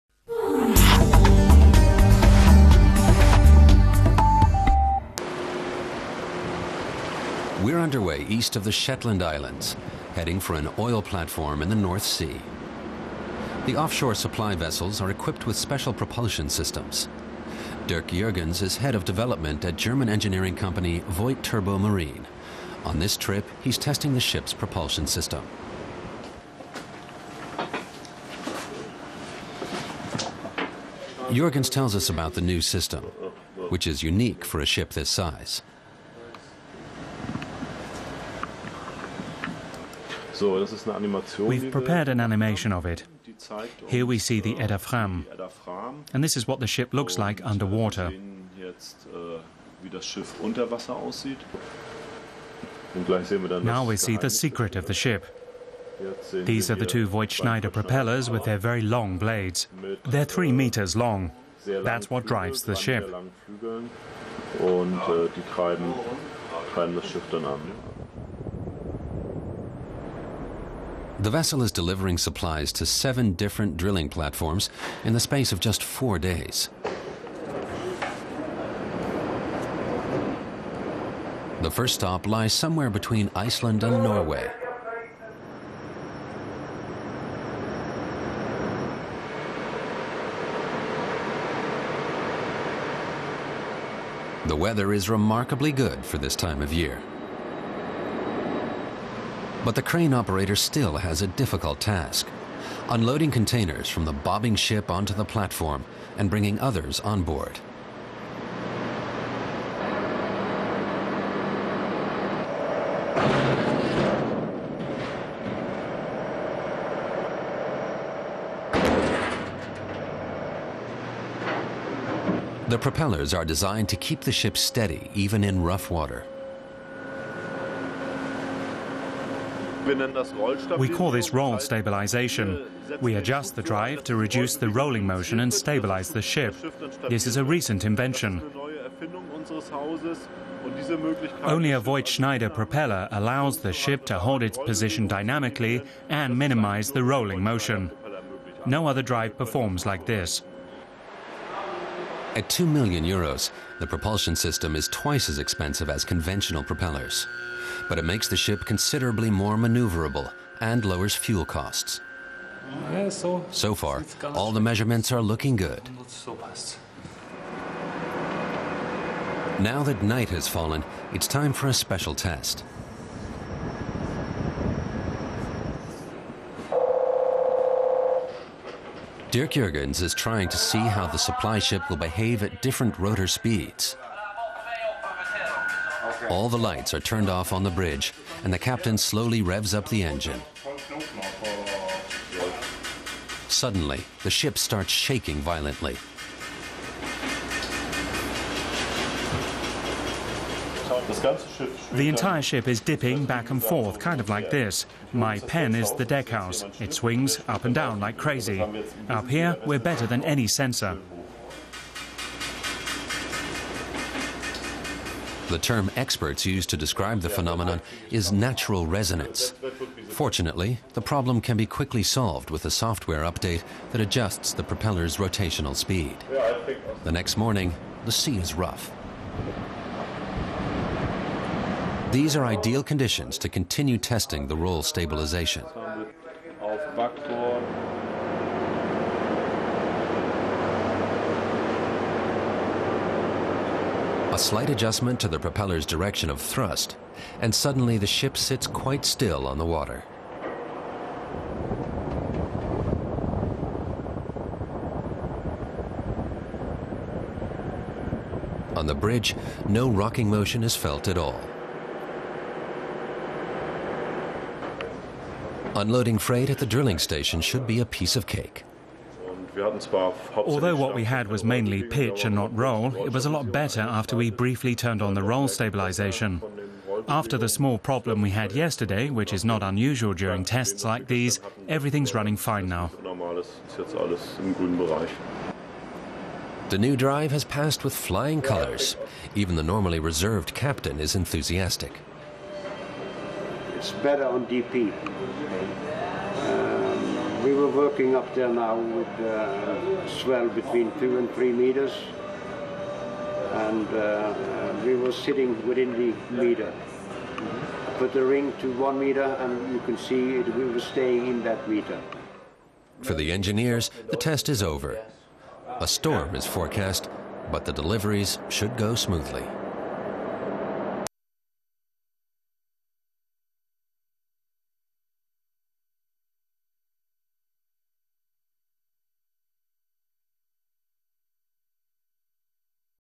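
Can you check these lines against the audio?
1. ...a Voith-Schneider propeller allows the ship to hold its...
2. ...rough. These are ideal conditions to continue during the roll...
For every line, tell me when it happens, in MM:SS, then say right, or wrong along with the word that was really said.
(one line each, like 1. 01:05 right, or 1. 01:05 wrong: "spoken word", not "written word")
1. 02:21 right
2. 03:48 wrong: "testing", not "during".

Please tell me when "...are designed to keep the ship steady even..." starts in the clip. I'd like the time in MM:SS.
02:03.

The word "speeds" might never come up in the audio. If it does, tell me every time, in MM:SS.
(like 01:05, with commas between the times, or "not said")
03:03, 03:45.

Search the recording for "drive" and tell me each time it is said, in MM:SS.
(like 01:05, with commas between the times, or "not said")
01:02, 02:13, 02:29, 04:46.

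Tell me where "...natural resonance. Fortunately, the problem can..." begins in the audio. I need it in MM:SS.
03:38.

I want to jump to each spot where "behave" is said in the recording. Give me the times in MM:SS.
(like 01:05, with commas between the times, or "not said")
03:01.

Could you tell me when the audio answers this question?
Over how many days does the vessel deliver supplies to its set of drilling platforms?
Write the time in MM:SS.
01:15.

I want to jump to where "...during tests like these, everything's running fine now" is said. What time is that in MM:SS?
04:40.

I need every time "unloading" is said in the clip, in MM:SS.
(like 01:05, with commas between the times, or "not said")
01:42, 04:25.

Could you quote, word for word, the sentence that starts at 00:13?
The offshore supply vessels are equipped with special propulsion systems.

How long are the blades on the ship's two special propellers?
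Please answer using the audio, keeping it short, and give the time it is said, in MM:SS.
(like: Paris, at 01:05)
3 meters, at 01:00.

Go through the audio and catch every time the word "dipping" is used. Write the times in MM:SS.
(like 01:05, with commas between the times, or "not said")
03:22.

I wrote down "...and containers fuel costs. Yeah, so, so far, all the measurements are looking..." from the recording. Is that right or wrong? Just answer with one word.
wrong.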